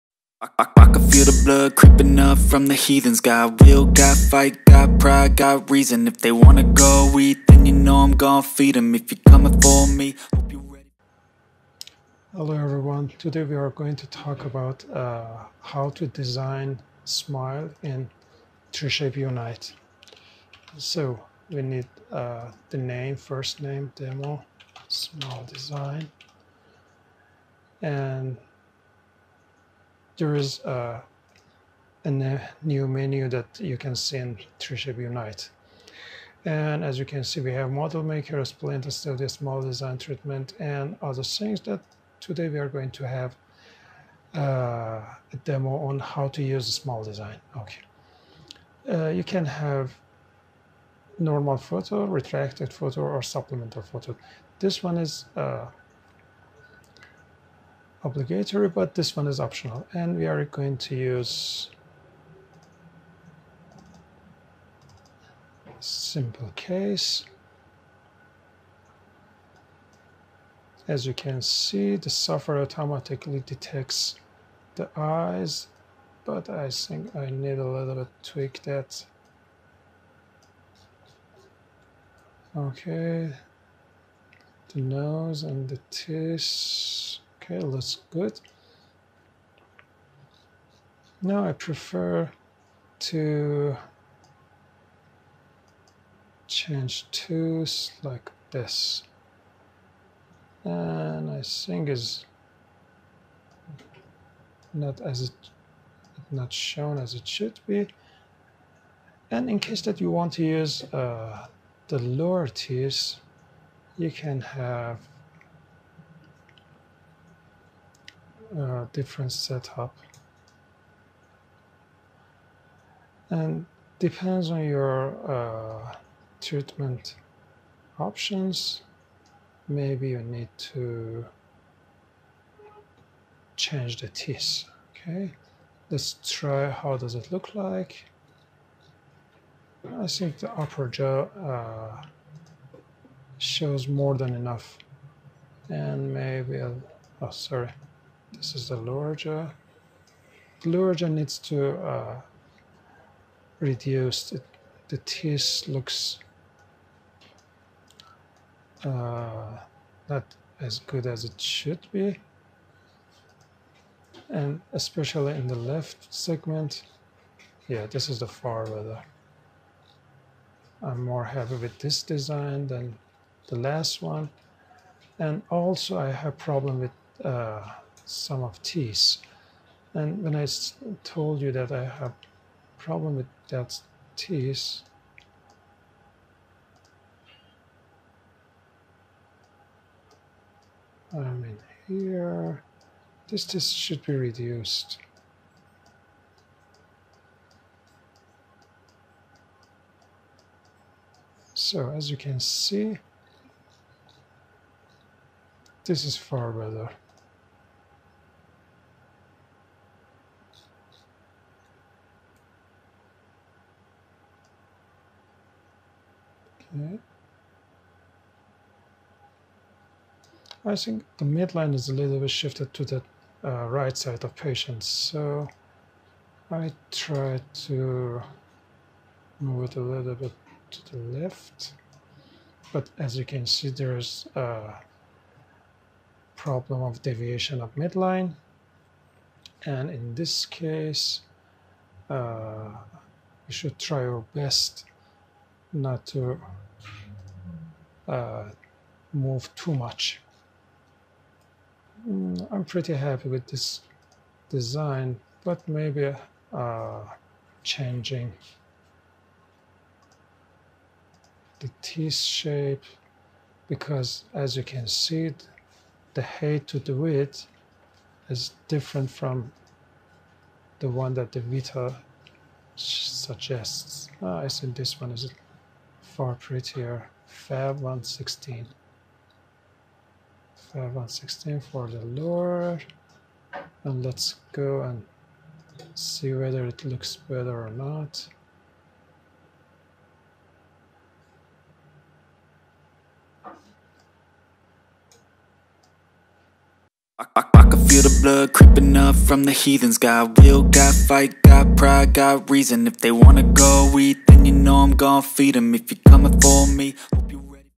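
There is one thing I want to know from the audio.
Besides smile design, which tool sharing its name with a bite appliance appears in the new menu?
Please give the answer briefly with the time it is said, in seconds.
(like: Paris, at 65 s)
splint studio, at 38 s.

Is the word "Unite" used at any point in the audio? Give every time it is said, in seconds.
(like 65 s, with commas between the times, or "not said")
19 s, 35 s.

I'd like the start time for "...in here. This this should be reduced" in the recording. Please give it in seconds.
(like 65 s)
191 s.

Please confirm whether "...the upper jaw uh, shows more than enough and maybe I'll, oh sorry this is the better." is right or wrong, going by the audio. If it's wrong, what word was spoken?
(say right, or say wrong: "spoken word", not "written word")
wrong: "larger", not "better".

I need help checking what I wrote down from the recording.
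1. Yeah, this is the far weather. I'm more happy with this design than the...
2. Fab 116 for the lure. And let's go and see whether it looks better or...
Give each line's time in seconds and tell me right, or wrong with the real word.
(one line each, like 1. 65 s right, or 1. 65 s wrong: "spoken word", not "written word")
1. 167 s right
2. 280 s right.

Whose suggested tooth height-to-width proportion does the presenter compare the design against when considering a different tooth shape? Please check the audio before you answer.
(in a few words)
Vita.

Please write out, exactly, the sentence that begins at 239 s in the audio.
And in this case, uh, we should try our best not to uh, move too much.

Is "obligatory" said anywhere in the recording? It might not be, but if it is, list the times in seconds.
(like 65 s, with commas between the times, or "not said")
58 s.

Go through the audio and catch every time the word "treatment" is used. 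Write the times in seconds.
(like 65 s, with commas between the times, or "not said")
39 s, 126 s.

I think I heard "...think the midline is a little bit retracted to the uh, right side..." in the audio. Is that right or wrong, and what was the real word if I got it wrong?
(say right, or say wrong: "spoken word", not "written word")
wrong: "shifted", not "retracted".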